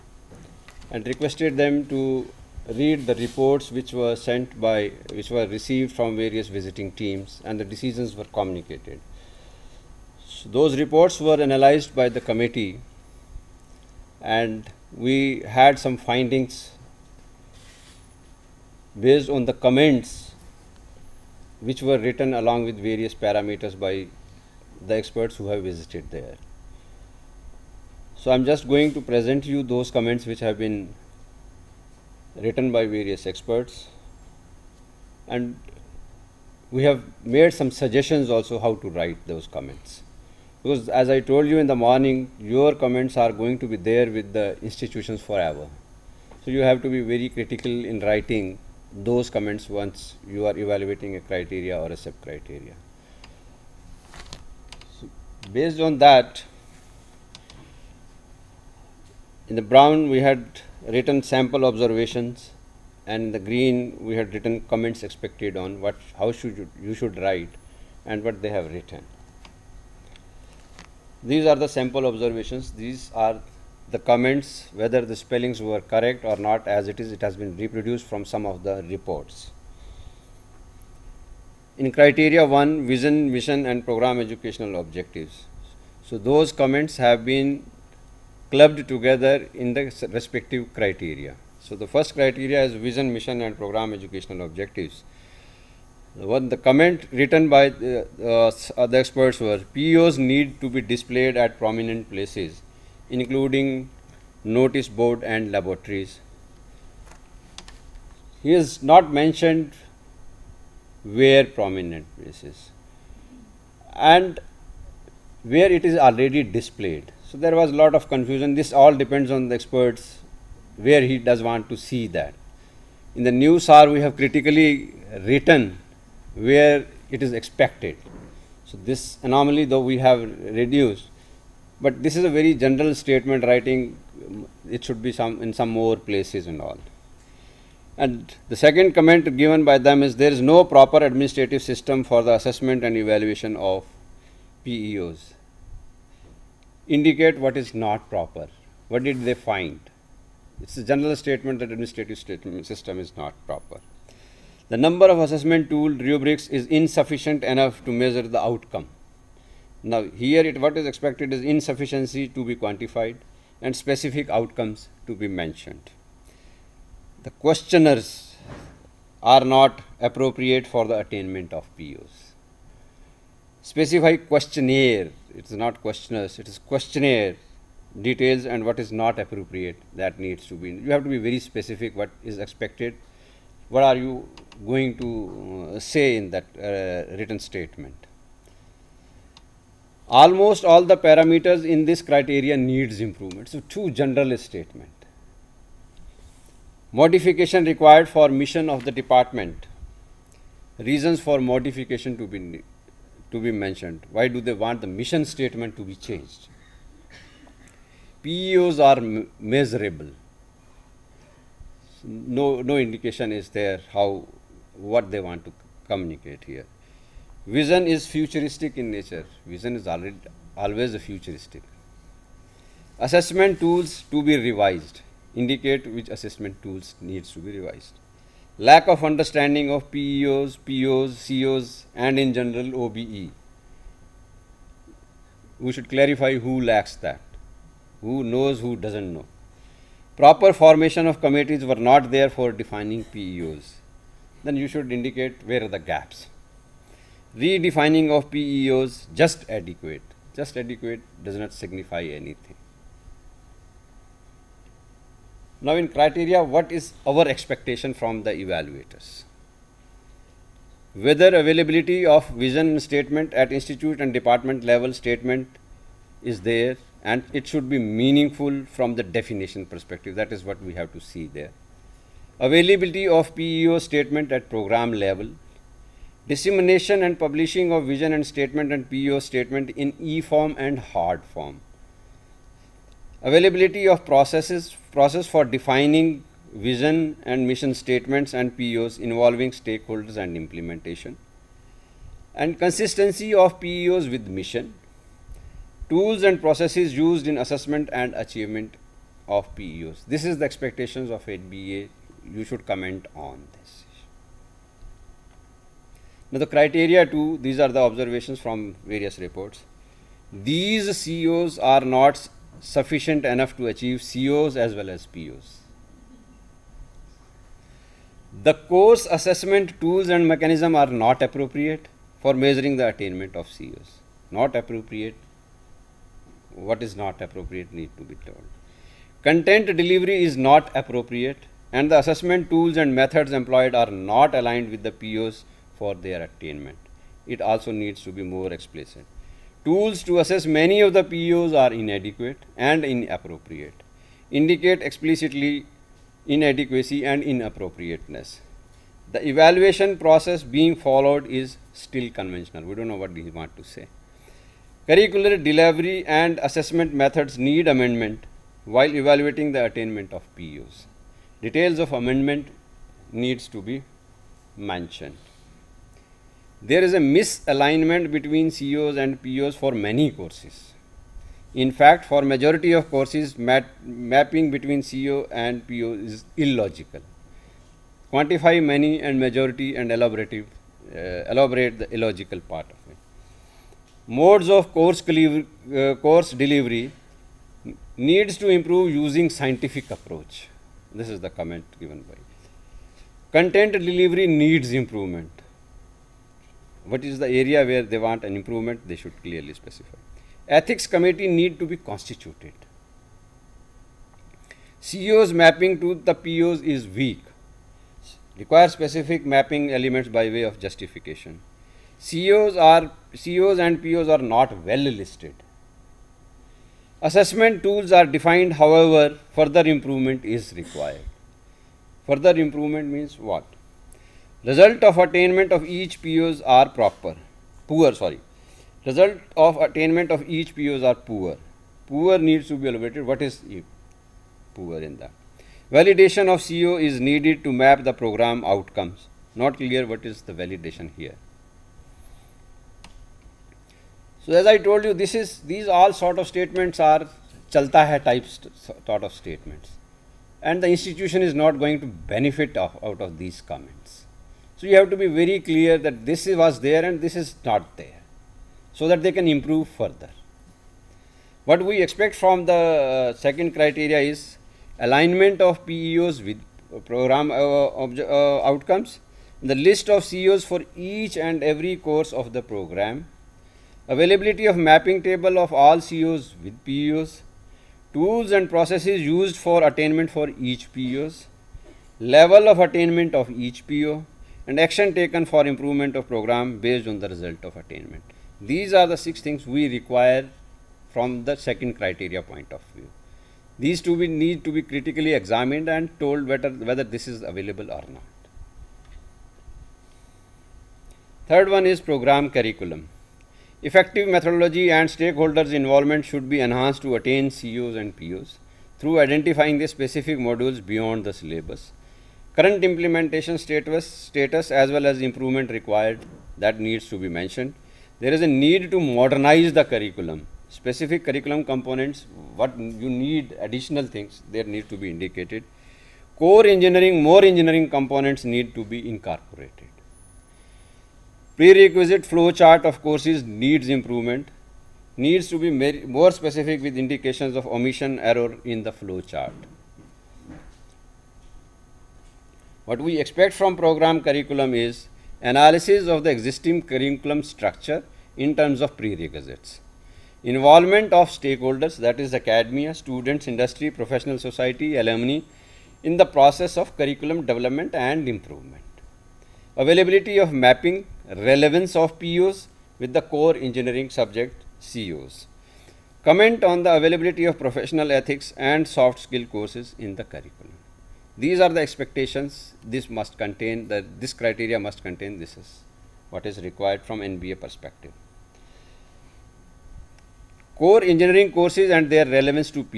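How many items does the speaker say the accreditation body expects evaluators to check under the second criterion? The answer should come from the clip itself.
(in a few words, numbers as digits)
6.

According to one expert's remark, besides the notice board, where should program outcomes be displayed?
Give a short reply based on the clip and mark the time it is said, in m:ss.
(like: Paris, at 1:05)
Laboratories, at 1:45.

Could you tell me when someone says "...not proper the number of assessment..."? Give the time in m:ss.
2:33.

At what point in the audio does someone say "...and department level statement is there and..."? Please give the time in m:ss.
4:23.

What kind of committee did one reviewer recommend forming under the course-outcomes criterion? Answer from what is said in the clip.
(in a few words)
Ethics committee.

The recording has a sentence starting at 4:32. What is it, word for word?
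Availability of PEO statement at program level dissemination and publishing of vision and statement and PEO statement in e-form and hard form.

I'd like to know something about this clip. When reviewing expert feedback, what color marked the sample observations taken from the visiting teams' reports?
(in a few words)
Brown.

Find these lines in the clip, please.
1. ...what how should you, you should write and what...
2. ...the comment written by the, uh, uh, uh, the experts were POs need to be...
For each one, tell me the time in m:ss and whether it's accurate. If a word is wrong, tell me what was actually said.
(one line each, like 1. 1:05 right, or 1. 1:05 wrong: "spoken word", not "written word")
1. 1:05 right
2. 1:36 right.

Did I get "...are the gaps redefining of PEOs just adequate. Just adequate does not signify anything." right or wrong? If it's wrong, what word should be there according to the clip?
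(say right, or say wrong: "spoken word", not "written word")
right.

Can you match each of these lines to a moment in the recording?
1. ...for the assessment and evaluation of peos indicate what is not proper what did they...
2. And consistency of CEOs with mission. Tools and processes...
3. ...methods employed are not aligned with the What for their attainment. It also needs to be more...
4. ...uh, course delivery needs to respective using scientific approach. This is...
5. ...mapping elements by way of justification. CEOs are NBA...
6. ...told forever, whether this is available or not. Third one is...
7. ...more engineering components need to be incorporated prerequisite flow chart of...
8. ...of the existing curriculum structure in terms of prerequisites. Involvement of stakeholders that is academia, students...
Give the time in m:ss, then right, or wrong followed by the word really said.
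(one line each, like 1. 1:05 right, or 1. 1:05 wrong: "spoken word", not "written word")
1. 2:22 right
2. 4:52 wrong: "PEOs", not "CEOs"
3. 5:32 wrong: "POs", not "What"
4. 6:25 wrong: "improve", not "respective"
5. 6:49 wrong: "CEOs", not "NBA"
6. 8:15 wrong: "whether", not "forever"
7. 8:47 right
8. 9:05 right.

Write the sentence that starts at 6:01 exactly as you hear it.
Details of amendment needs to be mentioned.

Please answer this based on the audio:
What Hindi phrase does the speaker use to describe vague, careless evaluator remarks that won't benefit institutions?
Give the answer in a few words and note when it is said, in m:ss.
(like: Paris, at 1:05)
Chalta hai, at 7:27.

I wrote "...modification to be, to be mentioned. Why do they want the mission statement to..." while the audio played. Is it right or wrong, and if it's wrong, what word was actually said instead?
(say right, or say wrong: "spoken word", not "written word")
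right.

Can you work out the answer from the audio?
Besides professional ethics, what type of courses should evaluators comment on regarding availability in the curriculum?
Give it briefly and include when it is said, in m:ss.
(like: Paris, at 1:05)
Soft skill courses, at 9:28.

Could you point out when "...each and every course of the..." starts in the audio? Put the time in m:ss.
7:50.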